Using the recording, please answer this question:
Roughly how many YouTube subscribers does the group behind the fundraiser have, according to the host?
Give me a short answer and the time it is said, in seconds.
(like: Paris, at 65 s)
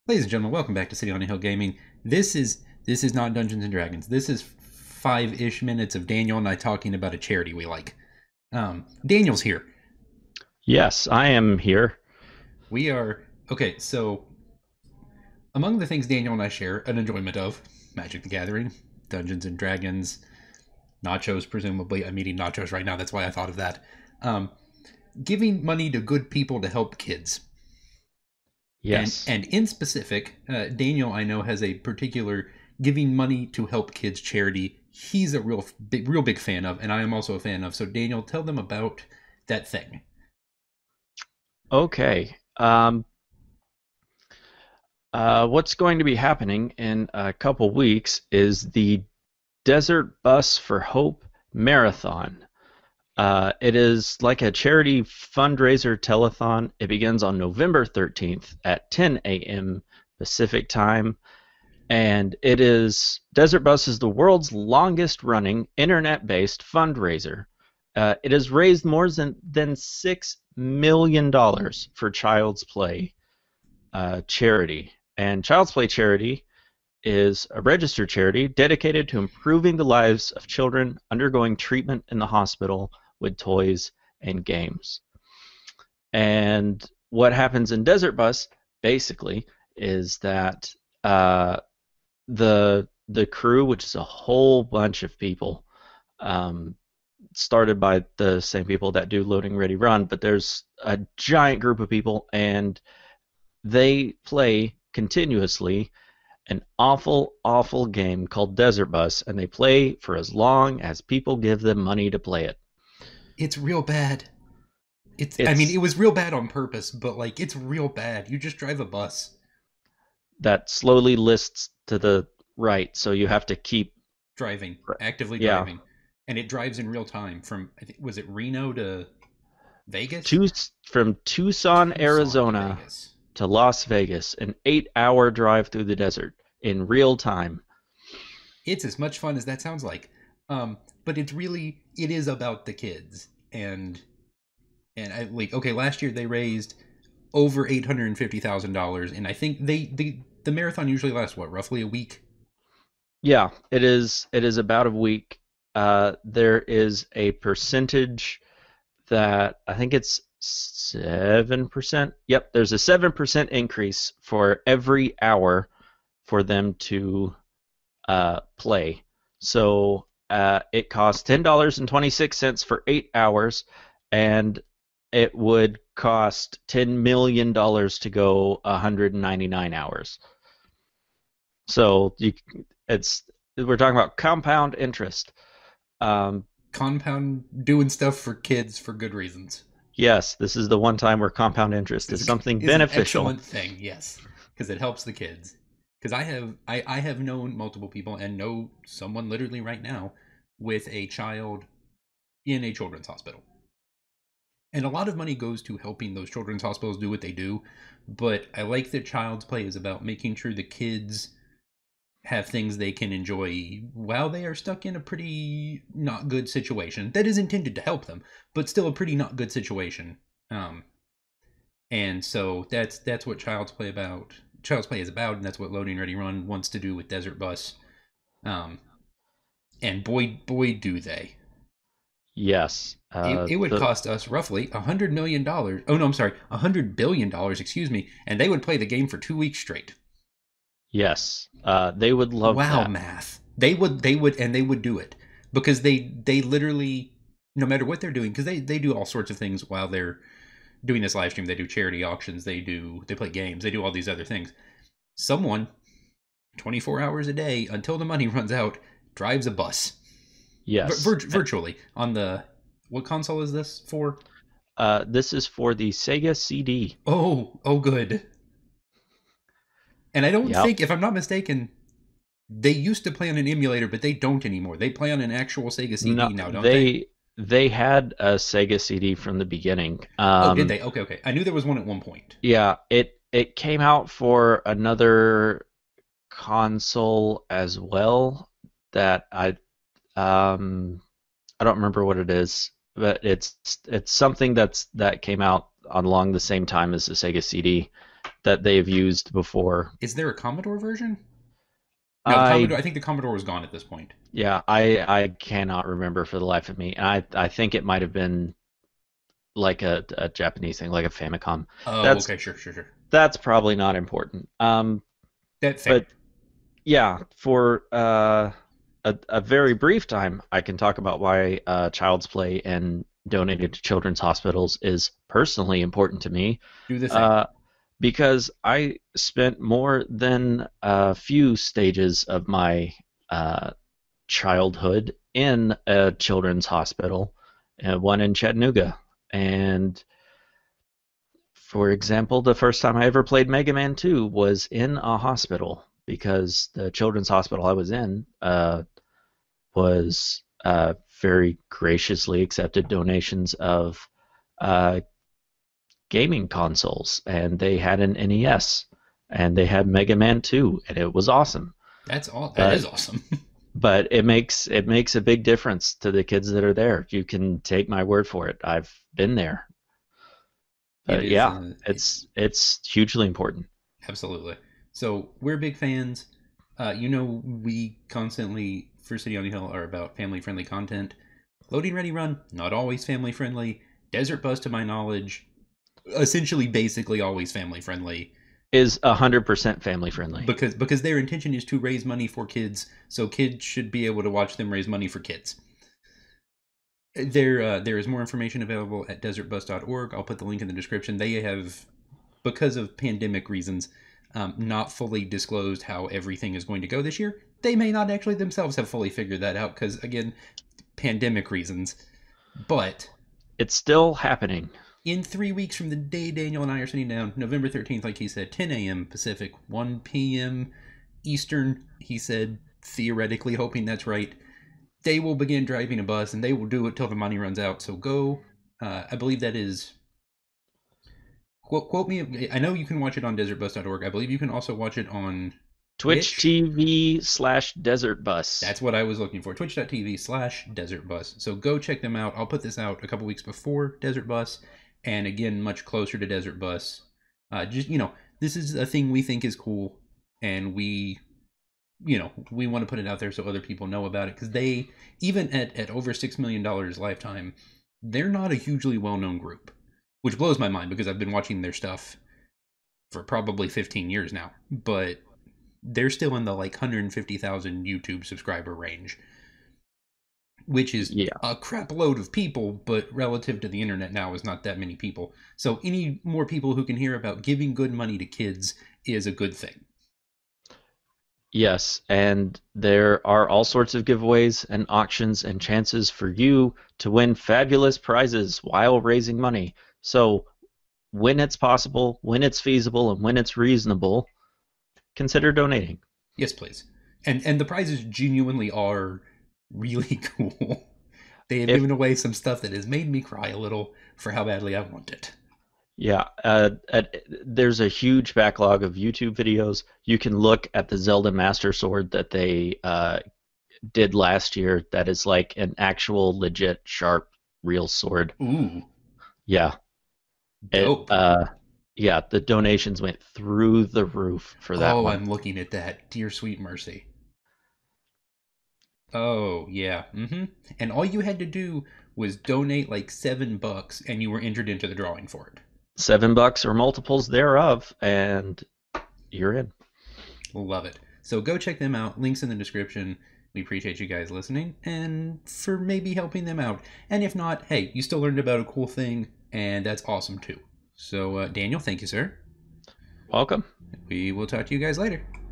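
150,000, at 466 s.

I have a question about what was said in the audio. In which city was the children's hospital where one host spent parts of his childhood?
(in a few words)
Chattanooga.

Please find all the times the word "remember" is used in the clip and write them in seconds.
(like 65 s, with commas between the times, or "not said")
291 s, 305 s.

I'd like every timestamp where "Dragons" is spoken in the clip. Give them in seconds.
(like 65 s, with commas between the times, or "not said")
3 s, 19 s.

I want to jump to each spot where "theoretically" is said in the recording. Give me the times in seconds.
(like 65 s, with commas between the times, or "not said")
422 s.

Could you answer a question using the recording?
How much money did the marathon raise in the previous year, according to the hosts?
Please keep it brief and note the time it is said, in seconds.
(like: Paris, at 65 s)
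over $850,000, at 147 s.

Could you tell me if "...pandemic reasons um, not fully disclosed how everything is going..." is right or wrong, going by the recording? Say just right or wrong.
right.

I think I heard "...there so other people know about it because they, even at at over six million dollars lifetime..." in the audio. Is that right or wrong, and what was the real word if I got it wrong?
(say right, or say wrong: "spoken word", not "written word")
right.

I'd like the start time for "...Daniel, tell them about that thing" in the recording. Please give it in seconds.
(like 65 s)
37 s.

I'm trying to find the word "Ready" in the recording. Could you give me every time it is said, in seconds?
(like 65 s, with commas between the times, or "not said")
99 s, 225 s, 381 s.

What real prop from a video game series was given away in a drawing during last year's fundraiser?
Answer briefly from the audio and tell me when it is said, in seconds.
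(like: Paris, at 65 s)
Zelda Master Sword, at 510 s.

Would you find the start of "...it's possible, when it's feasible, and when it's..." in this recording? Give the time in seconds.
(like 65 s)
491 s.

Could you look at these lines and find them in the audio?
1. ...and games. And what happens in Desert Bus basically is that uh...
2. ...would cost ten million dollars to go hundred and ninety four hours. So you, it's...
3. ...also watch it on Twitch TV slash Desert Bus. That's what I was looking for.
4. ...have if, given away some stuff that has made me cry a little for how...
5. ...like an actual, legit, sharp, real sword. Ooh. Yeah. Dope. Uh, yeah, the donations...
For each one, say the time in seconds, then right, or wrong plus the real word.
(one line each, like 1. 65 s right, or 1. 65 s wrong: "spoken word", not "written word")
1. 84 s right
2. 175 s wrong: "nine", not "four"
3. 434 s right
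4. 501 s right
5. 515 s right.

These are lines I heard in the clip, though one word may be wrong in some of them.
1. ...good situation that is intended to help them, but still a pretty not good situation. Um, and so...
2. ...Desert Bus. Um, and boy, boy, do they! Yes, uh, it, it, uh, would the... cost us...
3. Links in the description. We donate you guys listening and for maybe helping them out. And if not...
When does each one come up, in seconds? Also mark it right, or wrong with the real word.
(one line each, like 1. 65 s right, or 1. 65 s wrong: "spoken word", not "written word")
1. 216 s right
2. 227 s right
3. 542 s wrong: "appreciate", not "donate".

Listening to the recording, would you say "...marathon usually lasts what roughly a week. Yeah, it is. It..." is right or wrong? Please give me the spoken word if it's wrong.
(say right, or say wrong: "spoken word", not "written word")
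right.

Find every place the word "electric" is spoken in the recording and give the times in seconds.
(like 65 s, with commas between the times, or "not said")
not said.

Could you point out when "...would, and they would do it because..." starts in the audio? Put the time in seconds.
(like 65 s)
244 s.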